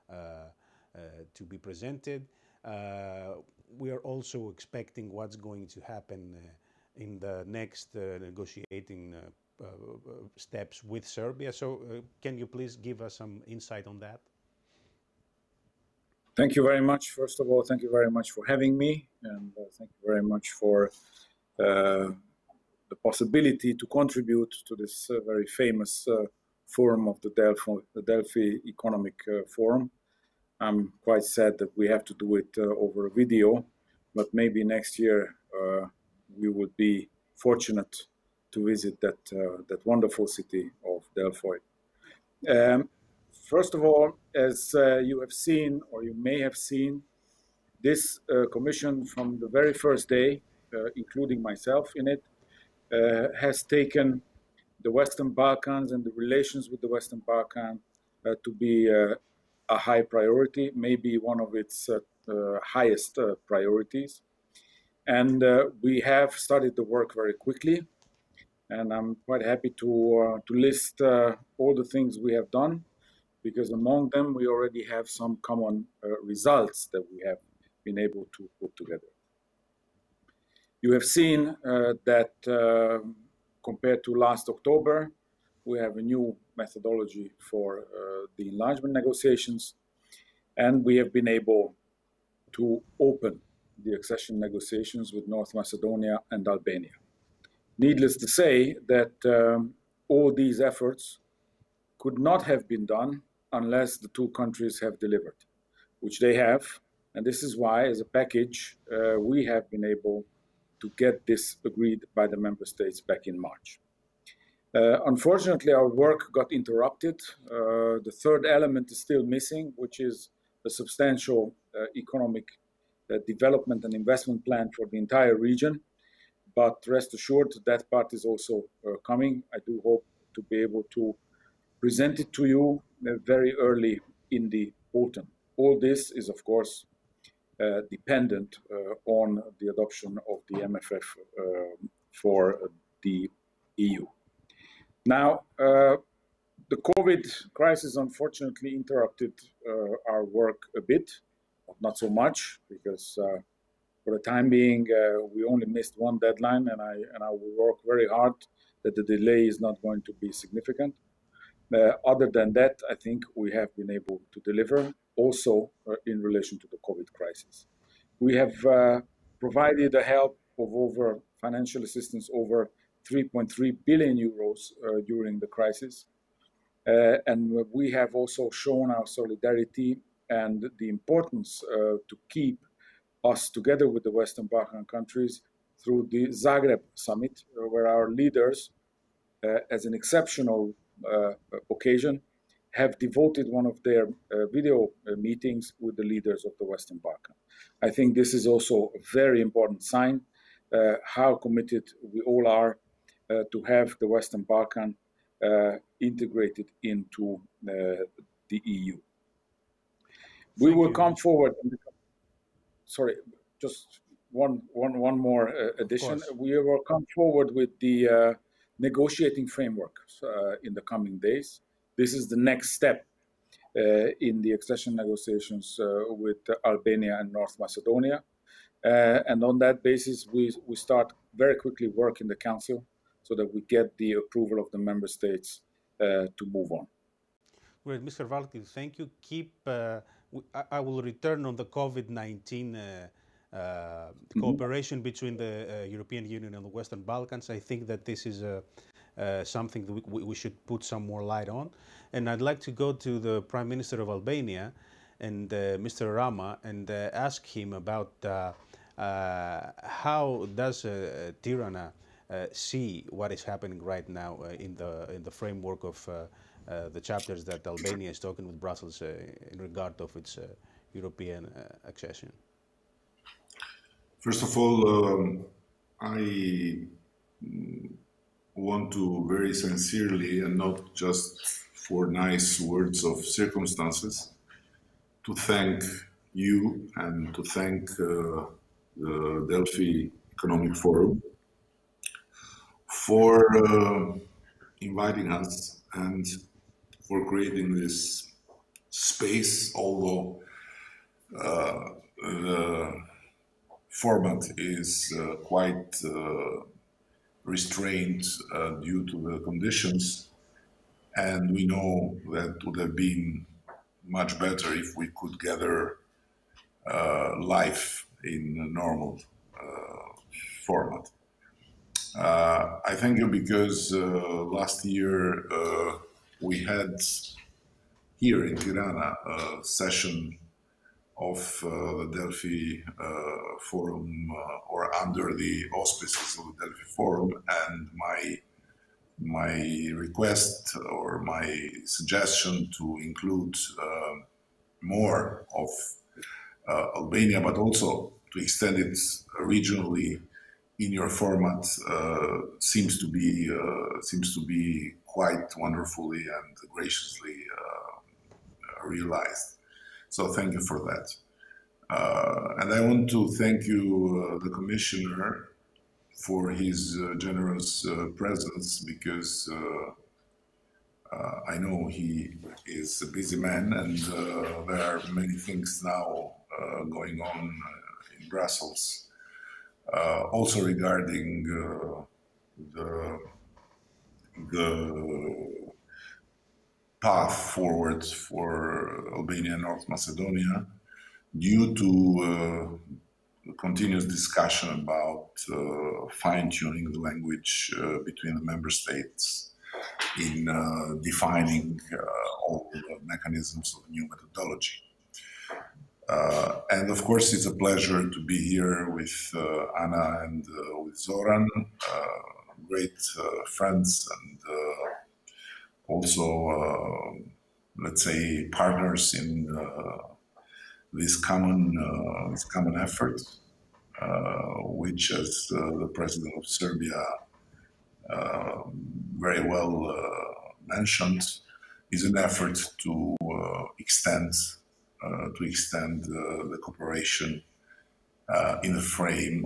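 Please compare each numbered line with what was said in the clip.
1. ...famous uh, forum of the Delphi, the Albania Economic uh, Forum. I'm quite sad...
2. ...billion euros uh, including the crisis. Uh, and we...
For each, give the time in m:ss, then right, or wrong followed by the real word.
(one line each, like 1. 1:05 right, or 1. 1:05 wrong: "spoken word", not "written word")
1. 0:25 wrong: "Delphi", not "Albania"
2. 2:53 wrong: "during", not "including".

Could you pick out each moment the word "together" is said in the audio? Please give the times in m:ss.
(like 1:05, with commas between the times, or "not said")
1:18, 3:03.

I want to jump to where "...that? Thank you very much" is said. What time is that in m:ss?
0:13.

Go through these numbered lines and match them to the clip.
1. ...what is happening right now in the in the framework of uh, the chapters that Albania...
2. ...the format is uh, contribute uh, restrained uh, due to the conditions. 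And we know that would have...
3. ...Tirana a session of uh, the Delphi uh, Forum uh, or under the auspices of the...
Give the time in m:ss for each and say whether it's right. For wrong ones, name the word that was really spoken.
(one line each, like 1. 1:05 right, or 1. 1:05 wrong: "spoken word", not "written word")
1. 4:23 right
2. 5:02 wrong: "quite", not "contribute"
3. 5:28 right.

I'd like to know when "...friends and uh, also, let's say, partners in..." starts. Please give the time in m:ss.
6:53.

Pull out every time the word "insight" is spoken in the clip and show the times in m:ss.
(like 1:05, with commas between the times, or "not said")
0:13.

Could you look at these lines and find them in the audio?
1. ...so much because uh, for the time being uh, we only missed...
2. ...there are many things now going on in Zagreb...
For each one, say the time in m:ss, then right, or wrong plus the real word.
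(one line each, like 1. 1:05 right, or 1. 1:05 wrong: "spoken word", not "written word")
1. 2:31 right
2. 6:14 wrong: "Brussels", not "Zagreb".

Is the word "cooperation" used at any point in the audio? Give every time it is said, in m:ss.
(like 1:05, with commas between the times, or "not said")
4:04, 7:16.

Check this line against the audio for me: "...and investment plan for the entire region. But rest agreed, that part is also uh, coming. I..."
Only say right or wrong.
wrong.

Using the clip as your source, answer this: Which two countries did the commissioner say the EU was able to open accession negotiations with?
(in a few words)
North Macedonia and Albania.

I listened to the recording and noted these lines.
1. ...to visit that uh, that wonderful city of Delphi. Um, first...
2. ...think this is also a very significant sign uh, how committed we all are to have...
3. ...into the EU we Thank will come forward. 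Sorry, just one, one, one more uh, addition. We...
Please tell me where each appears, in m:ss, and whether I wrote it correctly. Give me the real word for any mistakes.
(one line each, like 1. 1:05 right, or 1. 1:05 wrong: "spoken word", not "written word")
1. 0:38 right
2. 3:17 wrong: "important", not "significant"
3. 3:26 right.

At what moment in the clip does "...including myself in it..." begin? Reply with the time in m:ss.
0:50.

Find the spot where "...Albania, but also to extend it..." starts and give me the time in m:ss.
5:46.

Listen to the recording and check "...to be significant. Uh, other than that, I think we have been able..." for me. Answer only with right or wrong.
right.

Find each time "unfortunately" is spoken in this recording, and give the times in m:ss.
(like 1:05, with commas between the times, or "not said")
1:55, 2:27.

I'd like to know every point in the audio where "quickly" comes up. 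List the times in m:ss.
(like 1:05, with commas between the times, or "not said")
1:07, 3:51.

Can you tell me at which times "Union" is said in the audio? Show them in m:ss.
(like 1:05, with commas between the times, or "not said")
4:06.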